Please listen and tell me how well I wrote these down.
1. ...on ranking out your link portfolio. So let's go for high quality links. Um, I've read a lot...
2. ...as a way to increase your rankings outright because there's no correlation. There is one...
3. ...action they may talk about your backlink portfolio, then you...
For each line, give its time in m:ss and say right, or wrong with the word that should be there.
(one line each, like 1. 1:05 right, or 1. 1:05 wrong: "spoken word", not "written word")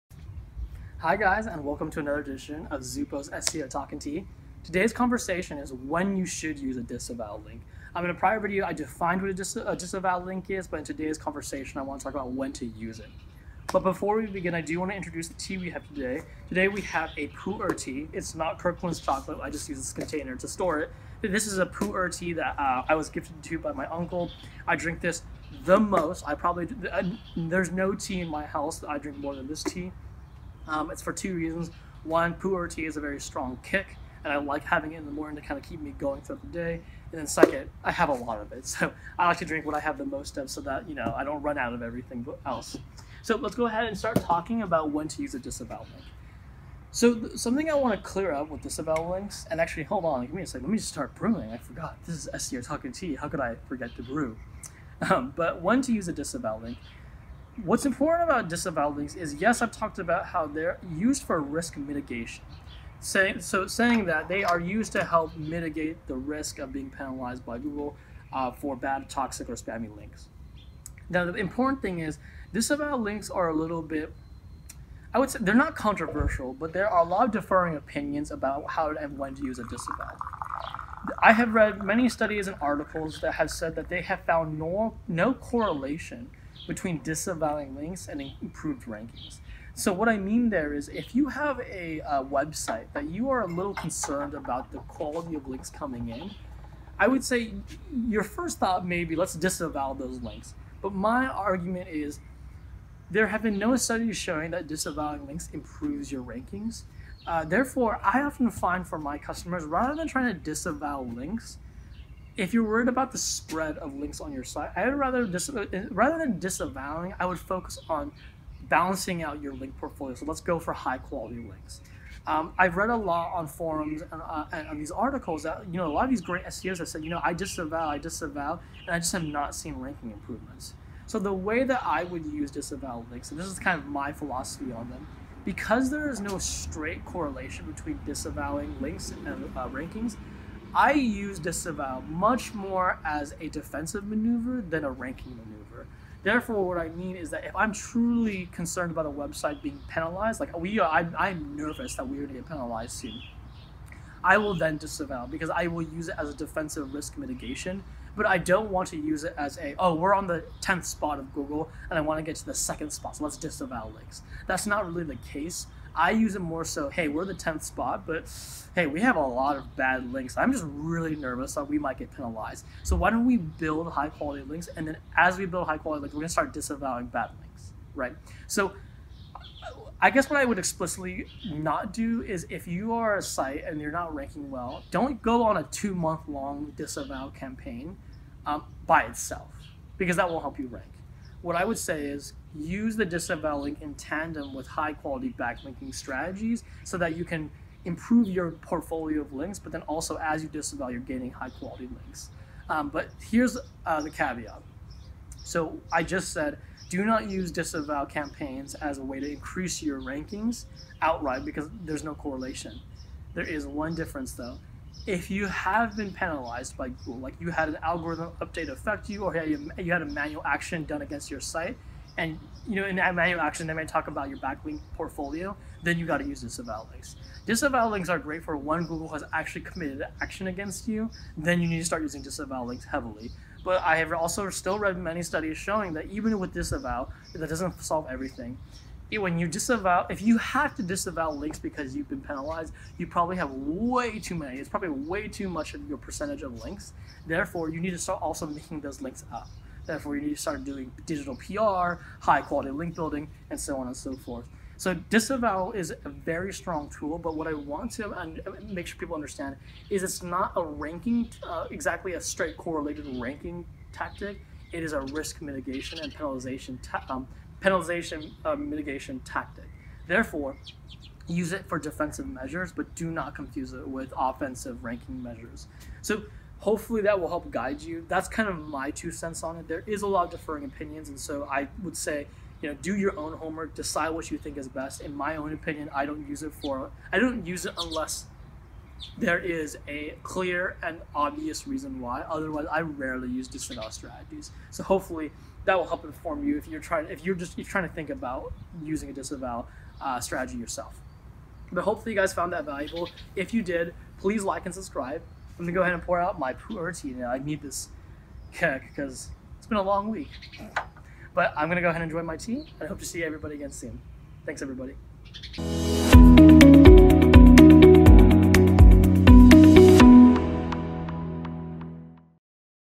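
1. 1:57 wrong: "balancing", not "ranking"
2. 3:28 right
3. 3:43 right.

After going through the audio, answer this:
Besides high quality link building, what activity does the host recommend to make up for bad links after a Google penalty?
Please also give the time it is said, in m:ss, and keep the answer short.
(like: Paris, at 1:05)
Digital PR, at 4:11.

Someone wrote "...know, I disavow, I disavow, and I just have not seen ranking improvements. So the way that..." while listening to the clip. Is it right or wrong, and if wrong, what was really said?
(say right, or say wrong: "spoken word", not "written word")
right.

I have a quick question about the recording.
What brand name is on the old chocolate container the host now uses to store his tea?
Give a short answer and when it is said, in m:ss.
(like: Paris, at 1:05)
Kirkland, at 0:18.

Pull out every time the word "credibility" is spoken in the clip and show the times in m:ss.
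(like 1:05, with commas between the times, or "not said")
not said.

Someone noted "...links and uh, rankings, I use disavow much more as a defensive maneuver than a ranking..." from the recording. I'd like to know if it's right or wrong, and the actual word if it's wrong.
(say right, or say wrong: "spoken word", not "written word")
right.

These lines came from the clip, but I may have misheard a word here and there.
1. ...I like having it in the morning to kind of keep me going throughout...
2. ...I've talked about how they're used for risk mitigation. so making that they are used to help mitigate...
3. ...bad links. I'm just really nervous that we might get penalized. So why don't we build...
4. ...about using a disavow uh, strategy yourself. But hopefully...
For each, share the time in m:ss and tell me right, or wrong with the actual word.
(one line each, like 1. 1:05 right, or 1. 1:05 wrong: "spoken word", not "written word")
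1. 0:34 right
2. 0:59 wrong: "saying", not "making"
3. 2:49 right
4. 4:58 right.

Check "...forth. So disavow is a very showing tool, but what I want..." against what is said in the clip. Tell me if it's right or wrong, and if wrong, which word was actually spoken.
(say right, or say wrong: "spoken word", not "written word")
wrong: "strong", not "showing".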